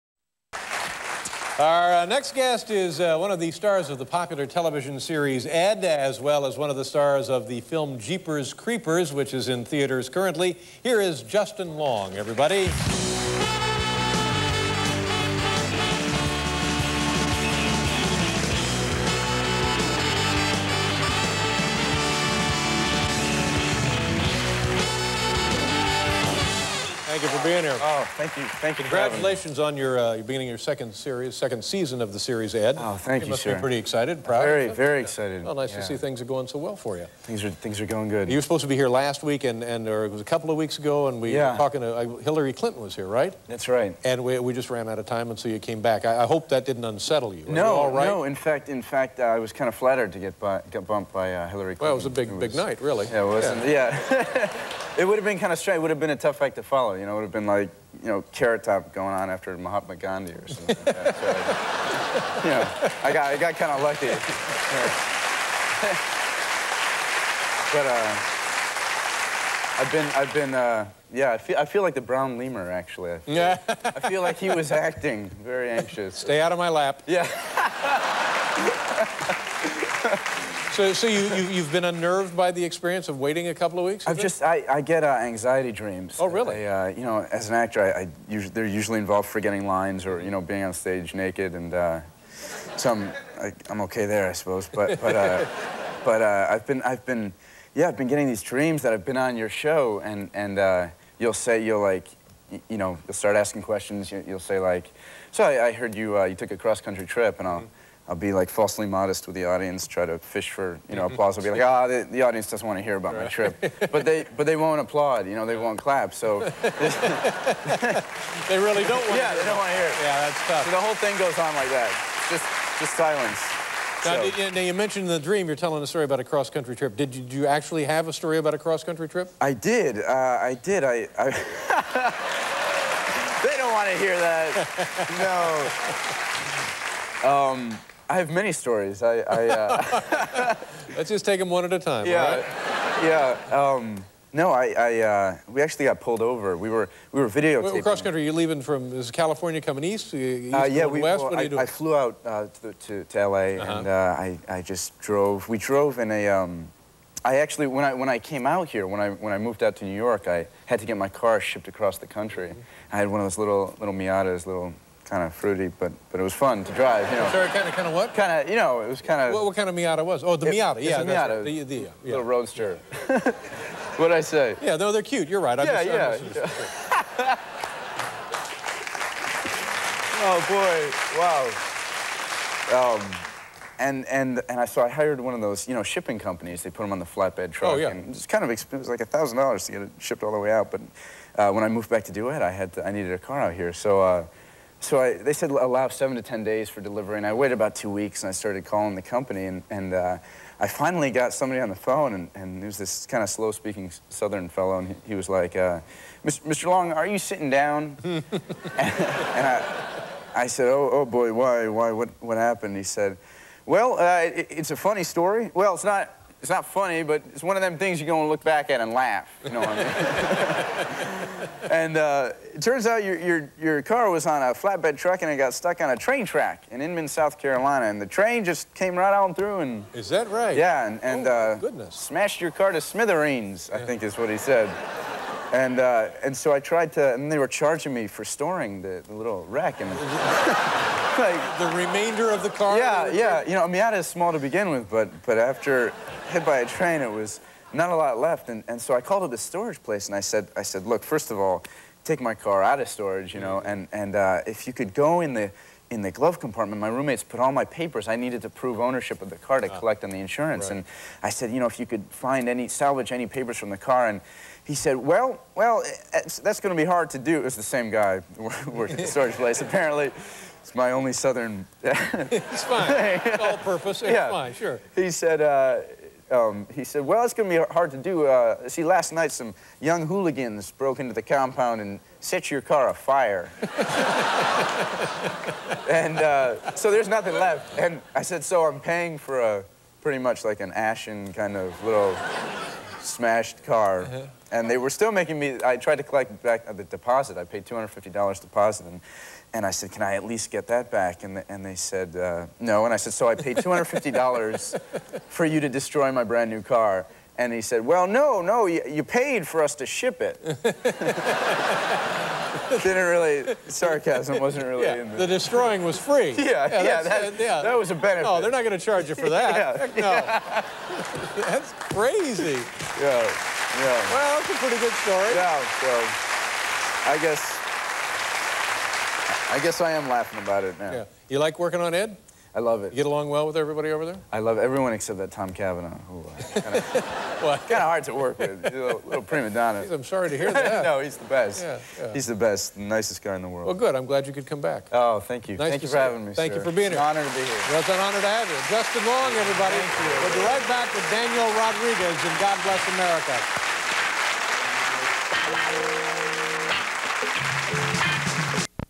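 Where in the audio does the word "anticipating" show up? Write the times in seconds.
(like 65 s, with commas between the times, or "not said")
not said.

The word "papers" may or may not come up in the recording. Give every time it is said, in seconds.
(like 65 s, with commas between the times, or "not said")
257 s, 263 s.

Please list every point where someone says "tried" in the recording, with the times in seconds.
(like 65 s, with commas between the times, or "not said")
236 s, 295 s.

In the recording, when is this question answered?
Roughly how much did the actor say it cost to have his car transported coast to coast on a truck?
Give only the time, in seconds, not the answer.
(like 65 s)
189 s.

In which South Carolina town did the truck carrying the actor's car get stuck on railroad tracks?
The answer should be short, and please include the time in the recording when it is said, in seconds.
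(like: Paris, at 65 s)
Inman, at 226 s.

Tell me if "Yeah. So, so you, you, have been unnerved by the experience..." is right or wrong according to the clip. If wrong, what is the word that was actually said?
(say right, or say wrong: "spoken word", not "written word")
right.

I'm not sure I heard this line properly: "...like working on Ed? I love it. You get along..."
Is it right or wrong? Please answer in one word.
right.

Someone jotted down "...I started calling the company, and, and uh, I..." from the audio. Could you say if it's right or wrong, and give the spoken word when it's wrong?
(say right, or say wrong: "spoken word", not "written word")
right.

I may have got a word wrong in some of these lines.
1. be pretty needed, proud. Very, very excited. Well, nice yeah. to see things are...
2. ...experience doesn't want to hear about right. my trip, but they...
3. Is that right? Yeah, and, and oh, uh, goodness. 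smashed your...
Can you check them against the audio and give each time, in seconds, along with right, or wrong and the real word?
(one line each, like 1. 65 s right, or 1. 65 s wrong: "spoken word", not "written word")
1. 33 s wrong: "excited", not "needed"
2. 112 s wrong: "audience", not "experience"
3. 229 s right.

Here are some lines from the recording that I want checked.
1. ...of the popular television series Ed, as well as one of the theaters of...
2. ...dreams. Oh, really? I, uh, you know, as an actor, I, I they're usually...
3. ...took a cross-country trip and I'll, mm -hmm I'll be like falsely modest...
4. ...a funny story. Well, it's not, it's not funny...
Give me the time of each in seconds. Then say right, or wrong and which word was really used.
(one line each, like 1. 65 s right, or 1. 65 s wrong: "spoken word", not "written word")
1. 3 s wrong: "stars", not "theaters"
2. 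85 s right
3. 106 s right
4. 214 s right.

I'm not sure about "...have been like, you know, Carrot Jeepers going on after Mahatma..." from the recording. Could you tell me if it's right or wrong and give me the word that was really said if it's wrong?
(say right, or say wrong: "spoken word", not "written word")
wrong: "Top", not "Jeepers".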